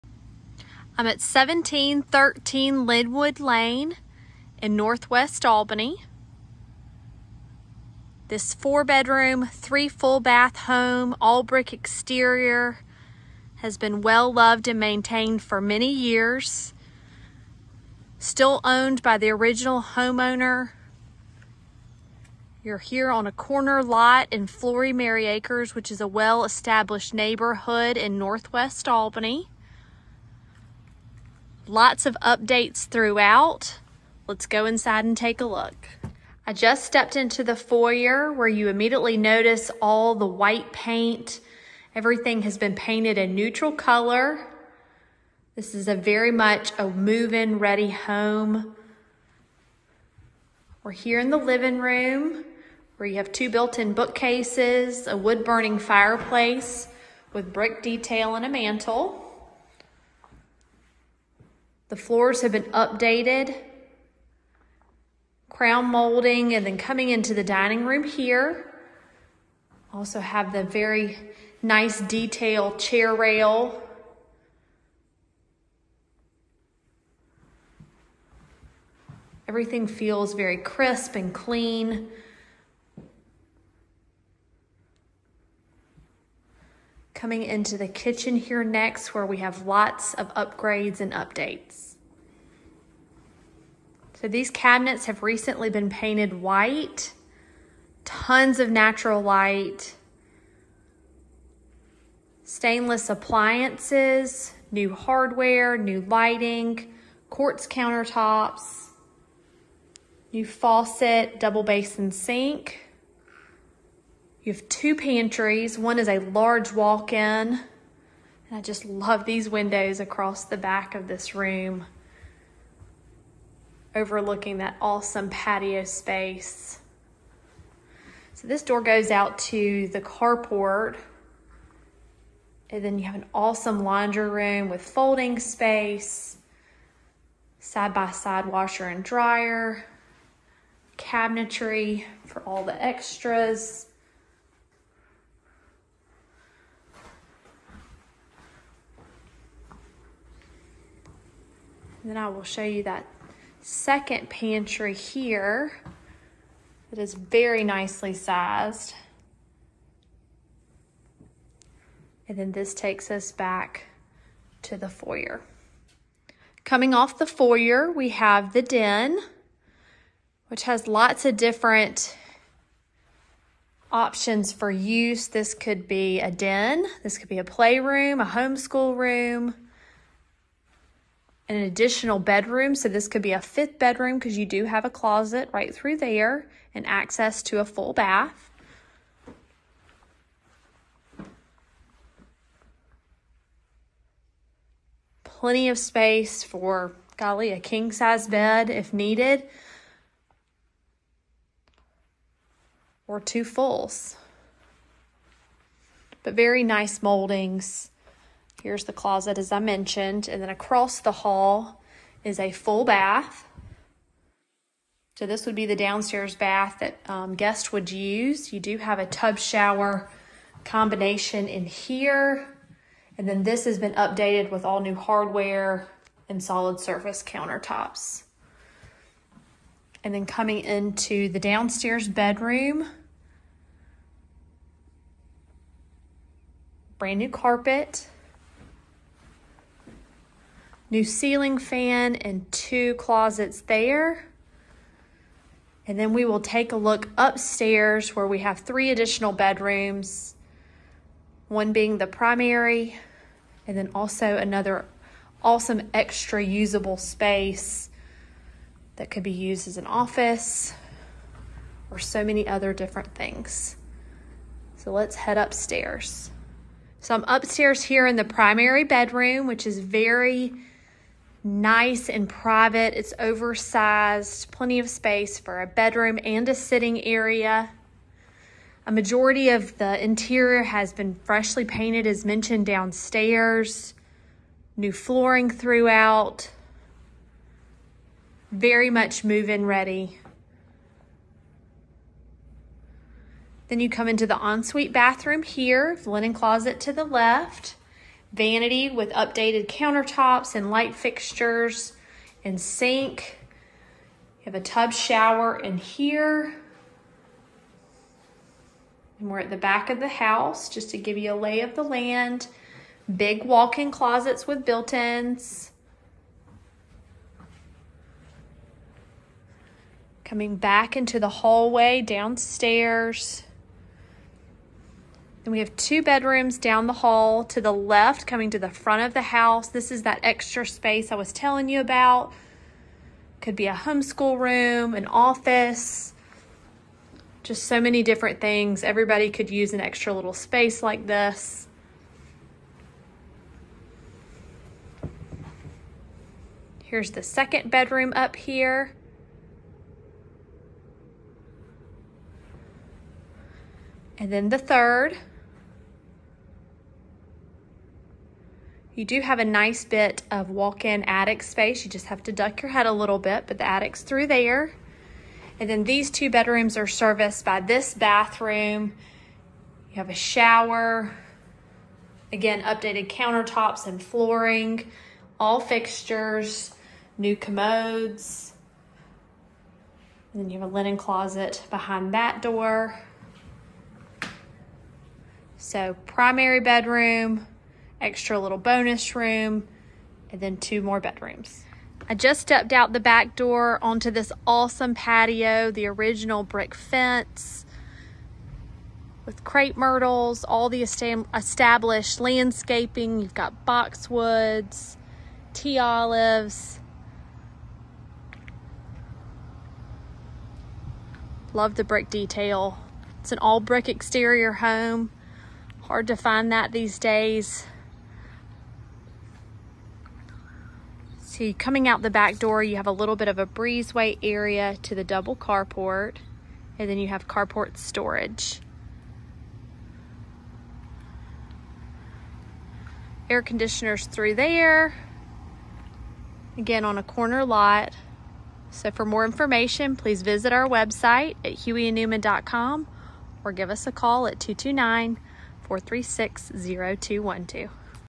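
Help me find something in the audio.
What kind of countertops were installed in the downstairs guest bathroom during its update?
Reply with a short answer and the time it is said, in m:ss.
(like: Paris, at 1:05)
Solid surface, at 3:46.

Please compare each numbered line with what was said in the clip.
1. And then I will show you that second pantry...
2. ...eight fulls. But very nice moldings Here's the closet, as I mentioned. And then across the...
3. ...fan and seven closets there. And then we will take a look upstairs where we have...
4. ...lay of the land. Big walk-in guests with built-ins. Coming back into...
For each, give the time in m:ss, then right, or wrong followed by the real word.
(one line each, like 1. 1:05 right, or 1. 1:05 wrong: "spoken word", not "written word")
1. 2:32 right
2. 3:23 wrong: "two", not "eight"
3. 4:01 wrong: "two", not "seven"
4. 5:11 wrong: "closets", not "guests".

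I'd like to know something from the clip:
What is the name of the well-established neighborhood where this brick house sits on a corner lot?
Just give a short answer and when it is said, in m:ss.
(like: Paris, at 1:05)
Flory Mary Acres, at 0:24.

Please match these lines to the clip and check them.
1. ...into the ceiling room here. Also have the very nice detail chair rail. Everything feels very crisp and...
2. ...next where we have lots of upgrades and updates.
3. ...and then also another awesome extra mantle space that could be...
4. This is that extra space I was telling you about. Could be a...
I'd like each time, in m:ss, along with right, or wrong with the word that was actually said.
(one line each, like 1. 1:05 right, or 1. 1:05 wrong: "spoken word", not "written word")
1. 1:07 wrong: "dining", not "ceiling"
2. 1:28 right
3. 4:13 wrong: "usable", not "mantle"
4. 5:29 right.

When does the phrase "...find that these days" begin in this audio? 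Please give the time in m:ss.
6:56.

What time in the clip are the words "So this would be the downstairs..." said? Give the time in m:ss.
3:35.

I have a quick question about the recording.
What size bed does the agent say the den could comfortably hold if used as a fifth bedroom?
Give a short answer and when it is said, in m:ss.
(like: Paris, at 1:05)
King size, at 3:17.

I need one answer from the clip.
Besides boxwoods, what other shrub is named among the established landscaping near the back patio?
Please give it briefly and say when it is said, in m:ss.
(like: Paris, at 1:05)
Tea olives, at 6:45.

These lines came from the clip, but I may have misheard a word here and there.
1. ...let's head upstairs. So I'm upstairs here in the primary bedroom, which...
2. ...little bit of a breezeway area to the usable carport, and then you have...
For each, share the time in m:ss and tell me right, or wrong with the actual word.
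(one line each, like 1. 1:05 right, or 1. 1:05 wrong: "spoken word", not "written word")
1. 4:24 right
2. 7:02 wrong: "double", not "usable".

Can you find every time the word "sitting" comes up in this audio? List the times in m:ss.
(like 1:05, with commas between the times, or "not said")
4:36.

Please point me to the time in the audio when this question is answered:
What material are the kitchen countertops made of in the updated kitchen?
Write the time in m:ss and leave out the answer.
1:47.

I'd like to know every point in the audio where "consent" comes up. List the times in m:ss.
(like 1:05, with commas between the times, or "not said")
not said.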